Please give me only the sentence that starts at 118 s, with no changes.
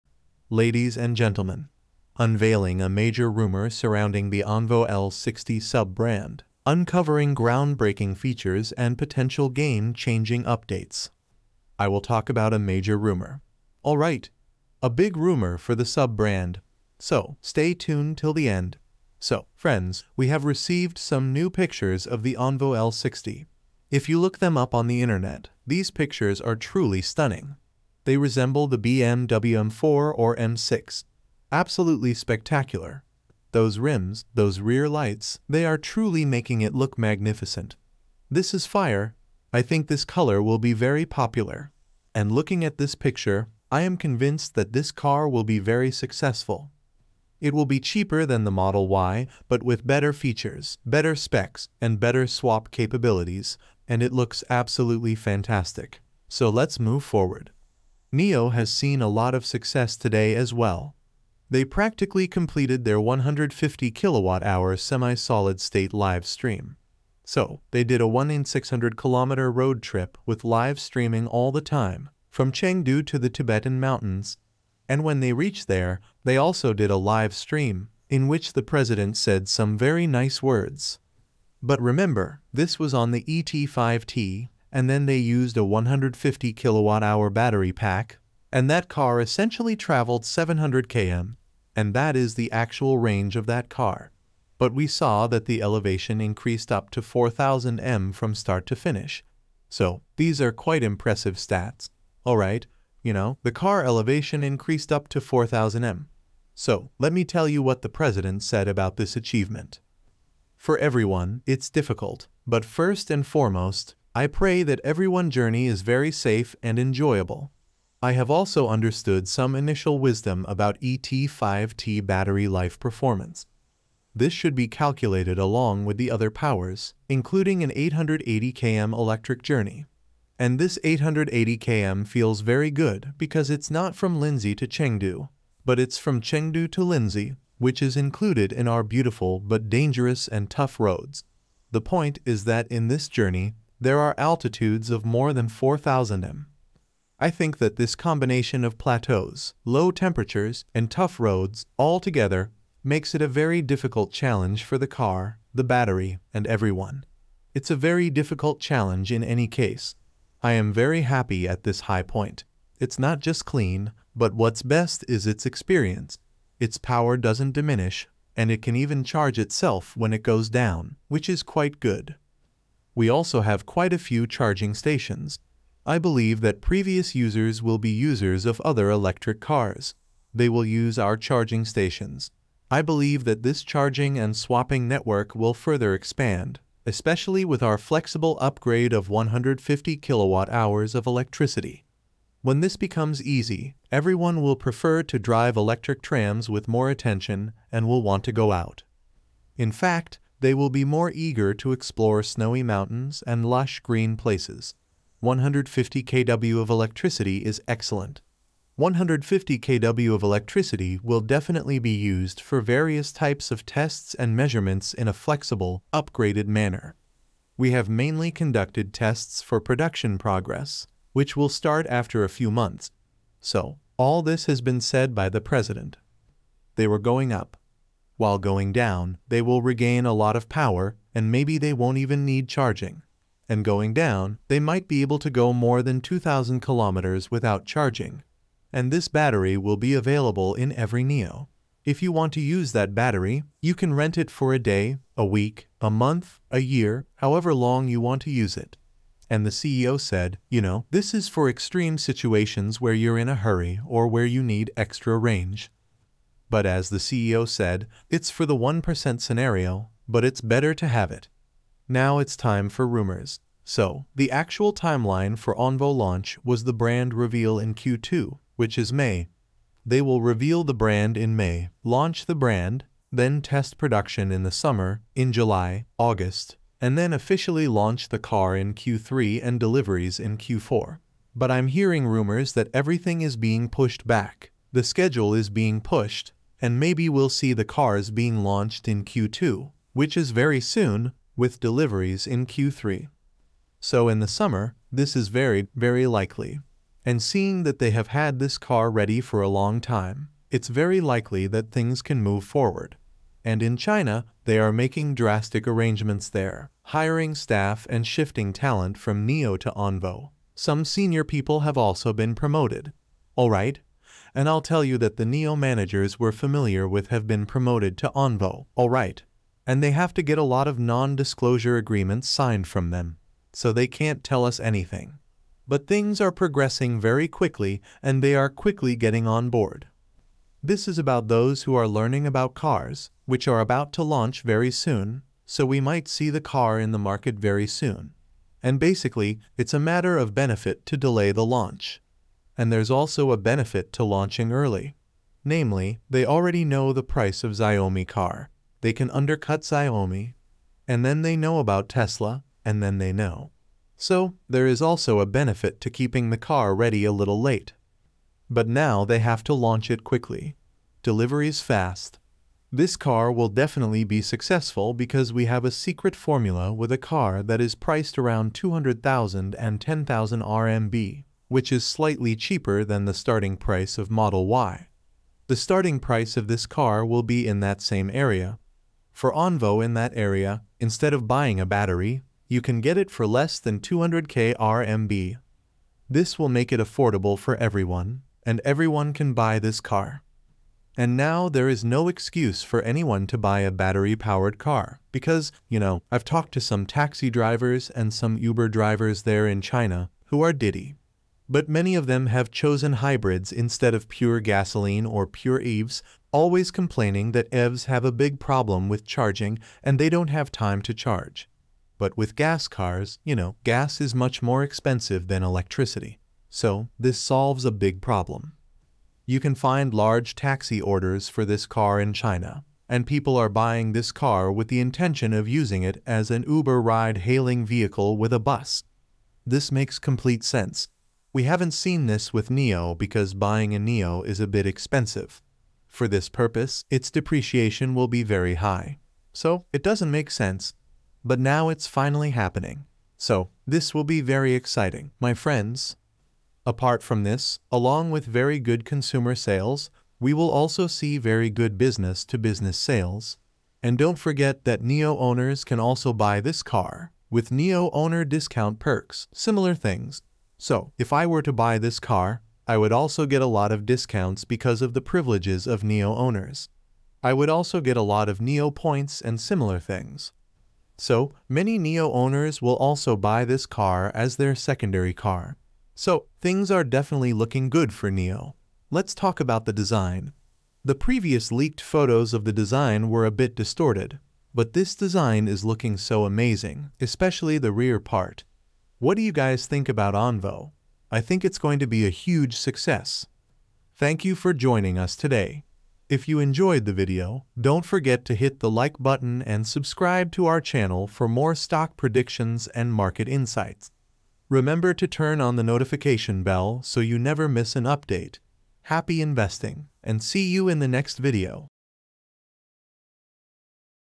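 I have also understood some initial wisdom about ET5T battery life performance.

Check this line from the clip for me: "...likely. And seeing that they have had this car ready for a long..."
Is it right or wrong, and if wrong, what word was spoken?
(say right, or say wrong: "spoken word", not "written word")
right.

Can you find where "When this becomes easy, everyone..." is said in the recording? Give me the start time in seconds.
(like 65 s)
192 s.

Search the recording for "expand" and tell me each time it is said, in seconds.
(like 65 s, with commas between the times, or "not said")
185 s.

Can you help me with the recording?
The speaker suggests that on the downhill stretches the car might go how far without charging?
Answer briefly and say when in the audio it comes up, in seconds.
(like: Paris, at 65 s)
2,000 kilometers, at 236 s.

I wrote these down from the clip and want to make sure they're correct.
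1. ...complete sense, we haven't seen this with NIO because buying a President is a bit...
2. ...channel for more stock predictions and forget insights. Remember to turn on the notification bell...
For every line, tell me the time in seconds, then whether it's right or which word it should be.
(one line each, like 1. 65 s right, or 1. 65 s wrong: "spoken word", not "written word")
1. 429 s wrong: "NIO", not "President"
2. 500 s wrong: "market", not "forget".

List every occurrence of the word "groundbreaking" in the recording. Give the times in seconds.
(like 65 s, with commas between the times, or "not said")
7 s.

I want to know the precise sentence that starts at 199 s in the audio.
In fact, they will be more eager to explore snowy mountains and lush green places.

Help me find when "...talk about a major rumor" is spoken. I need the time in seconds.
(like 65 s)
12 s.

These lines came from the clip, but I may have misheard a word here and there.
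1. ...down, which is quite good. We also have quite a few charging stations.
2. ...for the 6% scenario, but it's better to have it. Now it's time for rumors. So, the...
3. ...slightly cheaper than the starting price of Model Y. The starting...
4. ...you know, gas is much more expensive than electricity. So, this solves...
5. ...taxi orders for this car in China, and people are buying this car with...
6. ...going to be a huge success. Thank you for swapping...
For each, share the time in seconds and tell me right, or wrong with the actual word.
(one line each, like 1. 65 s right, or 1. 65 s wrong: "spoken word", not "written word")
1. 170 s right
2. 258 s wrong: "1", not "6"
3. 371 s right
4. 413 s right
5. 420 s right
6. 491 s wrong: "joining", not "swapping".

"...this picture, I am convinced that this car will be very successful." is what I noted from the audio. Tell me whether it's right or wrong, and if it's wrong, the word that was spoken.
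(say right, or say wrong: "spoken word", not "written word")
right.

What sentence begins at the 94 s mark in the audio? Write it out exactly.
But we saw that the elevation increased up to 4000 m from start to finish.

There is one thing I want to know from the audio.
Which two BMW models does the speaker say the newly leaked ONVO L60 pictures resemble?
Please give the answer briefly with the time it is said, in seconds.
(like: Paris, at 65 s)
M4 or M6, at 29 s.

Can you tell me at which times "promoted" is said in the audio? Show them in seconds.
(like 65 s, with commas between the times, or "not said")
312 s, 317 s.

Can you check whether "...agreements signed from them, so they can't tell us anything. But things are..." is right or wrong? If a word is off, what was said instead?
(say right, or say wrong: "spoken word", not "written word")
right.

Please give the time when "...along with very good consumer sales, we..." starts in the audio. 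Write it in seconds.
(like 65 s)
447 s.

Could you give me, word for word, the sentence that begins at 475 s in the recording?
So, things are definitely looking good for NIO.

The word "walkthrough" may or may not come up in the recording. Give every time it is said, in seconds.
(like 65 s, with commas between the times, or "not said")
not said.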